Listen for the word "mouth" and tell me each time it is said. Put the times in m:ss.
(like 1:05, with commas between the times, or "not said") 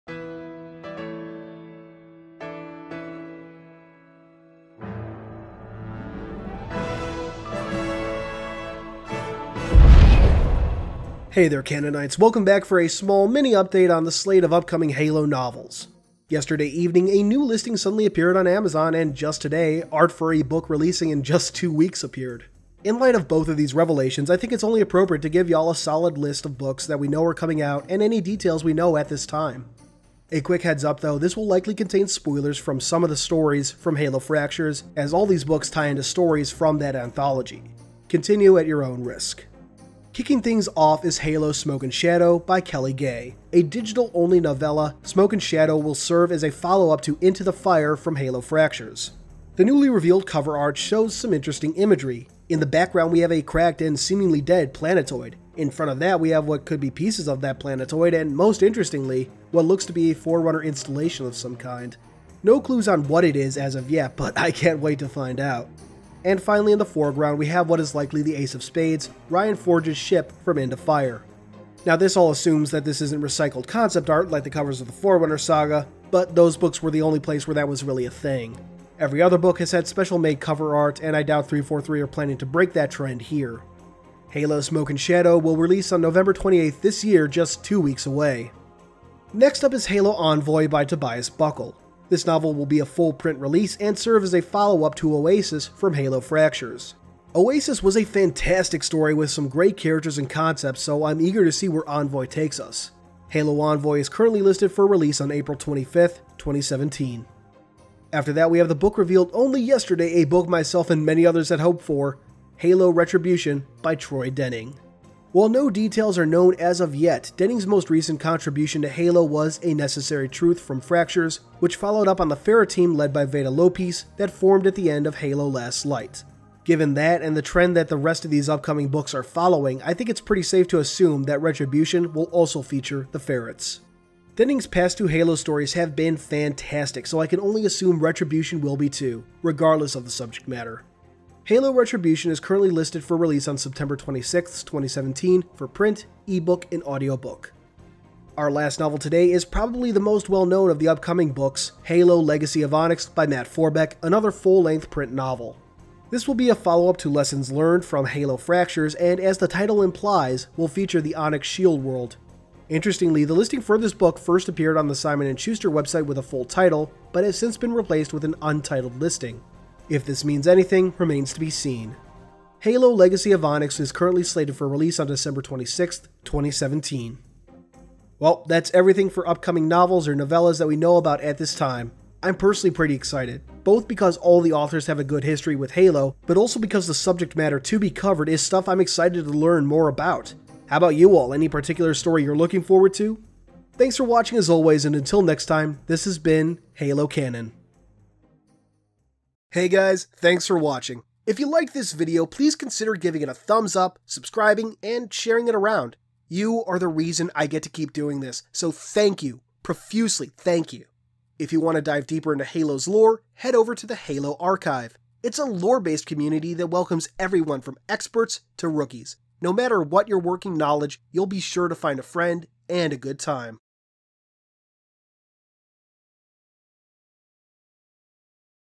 not said.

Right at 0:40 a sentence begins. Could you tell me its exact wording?
Kicking things off is Halo Smoke and Shadow by Kelly Gay.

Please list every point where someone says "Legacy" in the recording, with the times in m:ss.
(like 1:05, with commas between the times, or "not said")
2:32, 2:52.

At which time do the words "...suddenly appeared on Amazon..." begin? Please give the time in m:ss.
0:17.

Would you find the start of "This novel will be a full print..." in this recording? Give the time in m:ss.
1:32.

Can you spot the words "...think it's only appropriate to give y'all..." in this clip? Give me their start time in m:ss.
0:24.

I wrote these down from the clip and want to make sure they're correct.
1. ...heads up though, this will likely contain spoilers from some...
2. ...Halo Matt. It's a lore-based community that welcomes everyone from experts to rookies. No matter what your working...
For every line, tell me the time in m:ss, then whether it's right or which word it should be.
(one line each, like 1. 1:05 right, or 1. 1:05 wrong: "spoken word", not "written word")
1. 0:30 right
2. 3:33 wrong: "Archive", not "Matt".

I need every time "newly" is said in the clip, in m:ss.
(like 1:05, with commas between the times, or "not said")
0:49.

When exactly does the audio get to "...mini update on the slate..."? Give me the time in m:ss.
0:13.